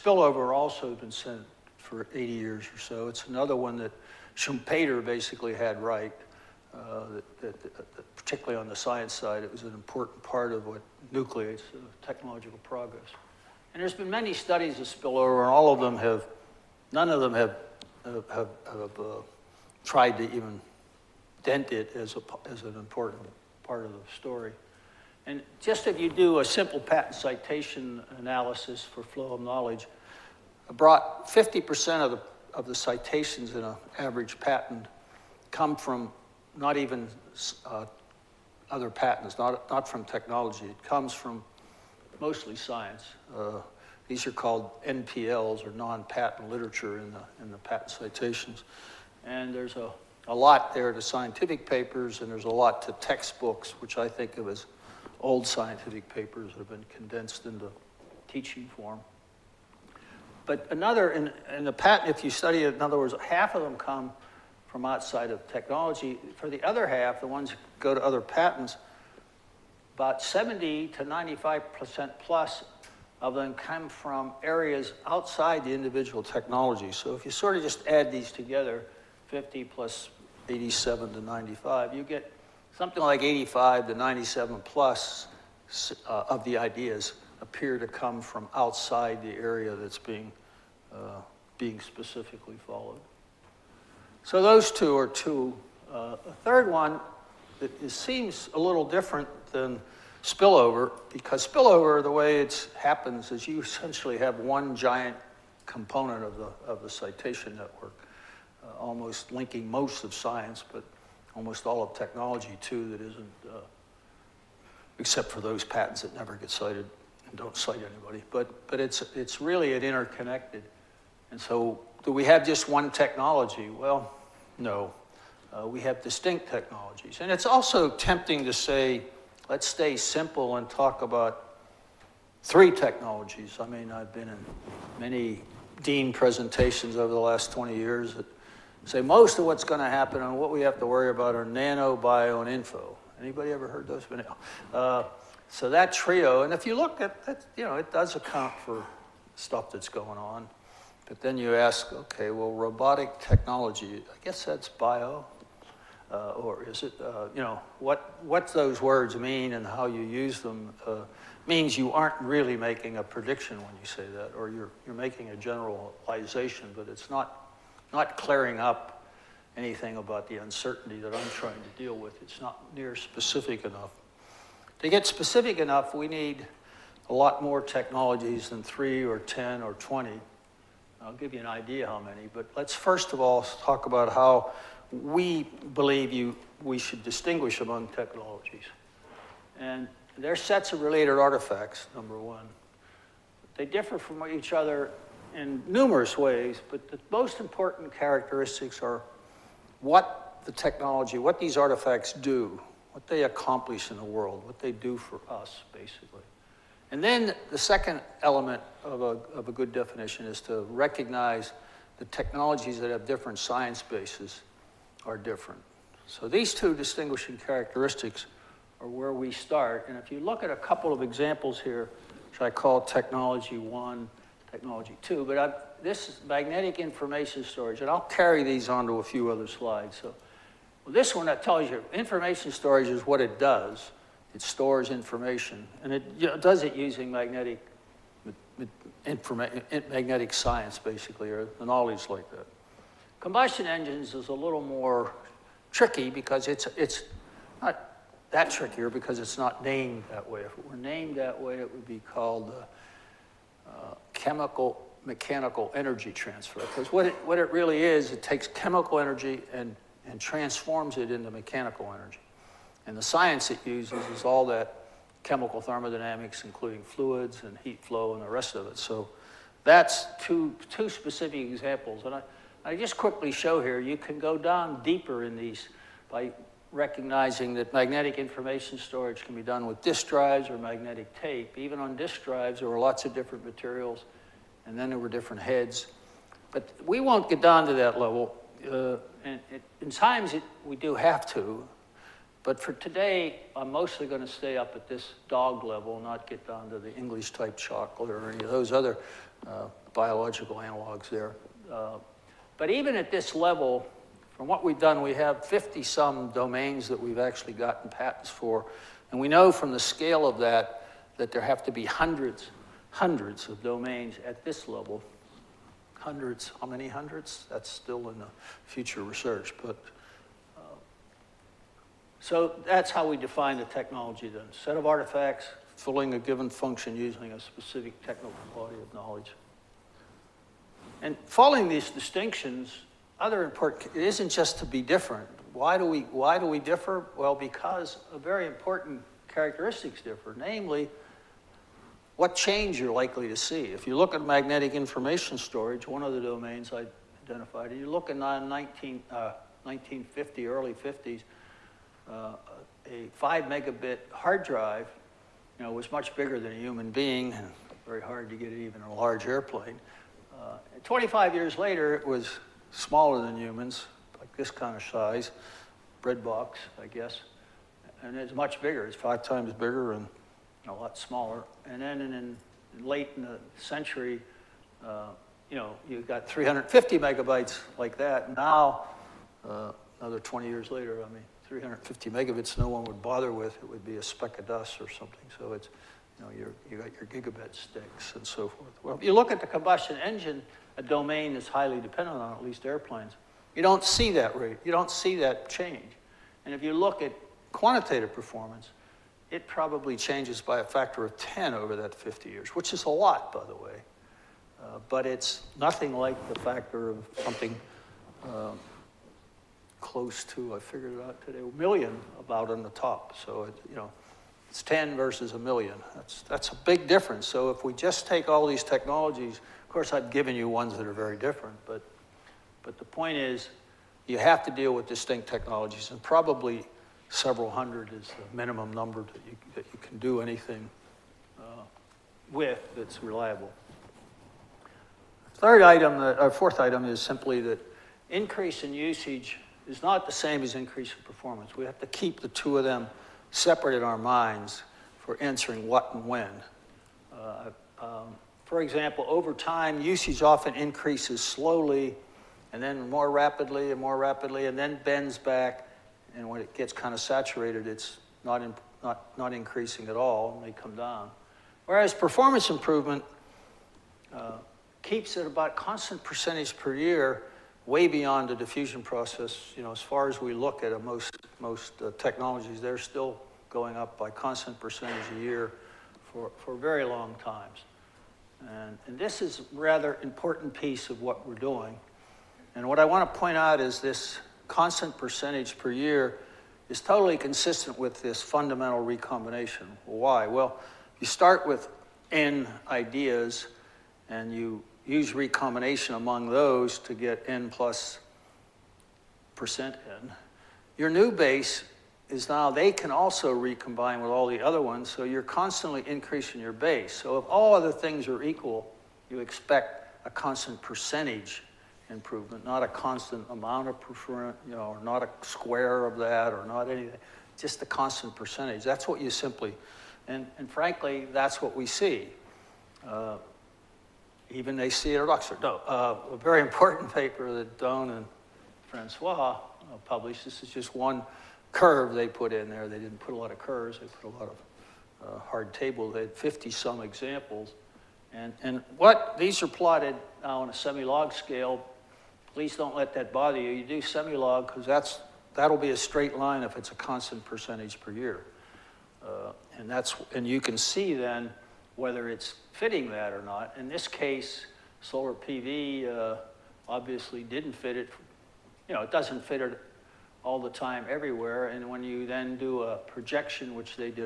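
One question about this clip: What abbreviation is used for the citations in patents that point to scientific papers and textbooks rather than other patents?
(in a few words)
NPLs.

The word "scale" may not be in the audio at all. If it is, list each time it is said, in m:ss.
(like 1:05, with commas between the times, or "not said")
5:09, 9:01.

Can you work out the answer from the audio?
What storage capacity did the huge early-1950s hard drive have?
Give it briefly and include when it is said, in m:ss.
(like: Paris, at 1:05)
5 megabits, at 5:53.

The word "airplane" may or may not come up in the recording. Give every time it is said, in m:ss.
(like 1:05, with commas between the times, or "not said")
5:59, 6:32.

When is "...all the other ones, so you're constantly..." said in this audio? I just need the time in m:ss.
8:24.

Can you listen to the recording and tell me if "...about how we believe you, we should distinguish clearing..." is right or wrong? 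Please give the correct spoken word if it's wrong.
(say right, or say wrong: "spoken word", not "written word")
wrong: "among", not "clearing".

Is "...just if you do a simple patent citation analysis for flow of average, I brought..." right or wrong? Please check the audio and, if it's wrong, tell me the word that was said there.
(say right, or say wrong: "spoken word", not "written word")
wrong: "knowledge", not "average".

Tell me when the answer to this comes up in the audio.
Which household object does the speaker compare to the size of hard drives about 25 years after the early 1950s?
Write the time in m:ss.
6:06.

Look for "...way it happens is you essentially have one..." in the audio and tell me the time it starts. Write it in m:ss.
1:42.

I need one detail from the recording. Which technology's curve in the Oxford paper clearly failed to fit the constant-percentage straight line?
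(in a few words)
Solar PV.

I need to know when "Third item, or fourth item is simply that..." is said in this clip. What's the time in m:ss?
7:15.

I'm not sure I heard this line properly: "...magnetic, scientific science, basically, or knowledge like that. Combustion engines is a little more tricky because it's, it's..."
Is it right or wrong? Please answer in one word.
wrong.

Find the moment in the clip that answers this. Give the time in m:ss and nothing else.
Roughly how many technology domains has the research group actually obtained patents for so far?
5:05.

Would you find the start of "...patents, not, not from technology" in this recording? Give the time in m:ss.
0:38.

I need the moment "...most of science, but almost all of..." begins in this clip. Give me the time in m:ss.
1:49.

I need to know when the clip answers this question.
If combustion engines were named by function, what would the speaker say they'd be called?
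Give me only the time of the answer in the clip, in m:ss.
4:14.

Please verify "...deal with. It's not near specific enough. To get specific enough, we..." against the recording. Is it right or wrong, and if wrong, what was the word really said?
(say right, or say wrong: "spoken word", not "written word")
right.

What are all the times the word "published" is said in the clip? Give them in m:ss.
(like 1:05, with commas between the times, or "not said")
8:49.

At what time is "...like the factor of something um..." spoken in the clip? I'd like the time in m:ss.
6:45.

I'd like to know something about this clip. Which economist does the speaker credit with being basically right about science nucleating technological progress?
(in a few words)
Schumpeter.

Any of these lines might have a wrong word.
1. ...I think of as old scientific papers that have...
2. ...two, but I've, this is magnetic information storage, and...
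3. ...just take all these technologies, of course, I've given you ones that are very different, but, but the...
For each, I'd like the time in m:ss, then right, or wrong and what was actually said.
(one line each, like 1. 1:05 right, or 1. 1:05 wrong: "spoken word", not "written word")
1. 0:53 right
2. 3:45 right
3. 6:57 right.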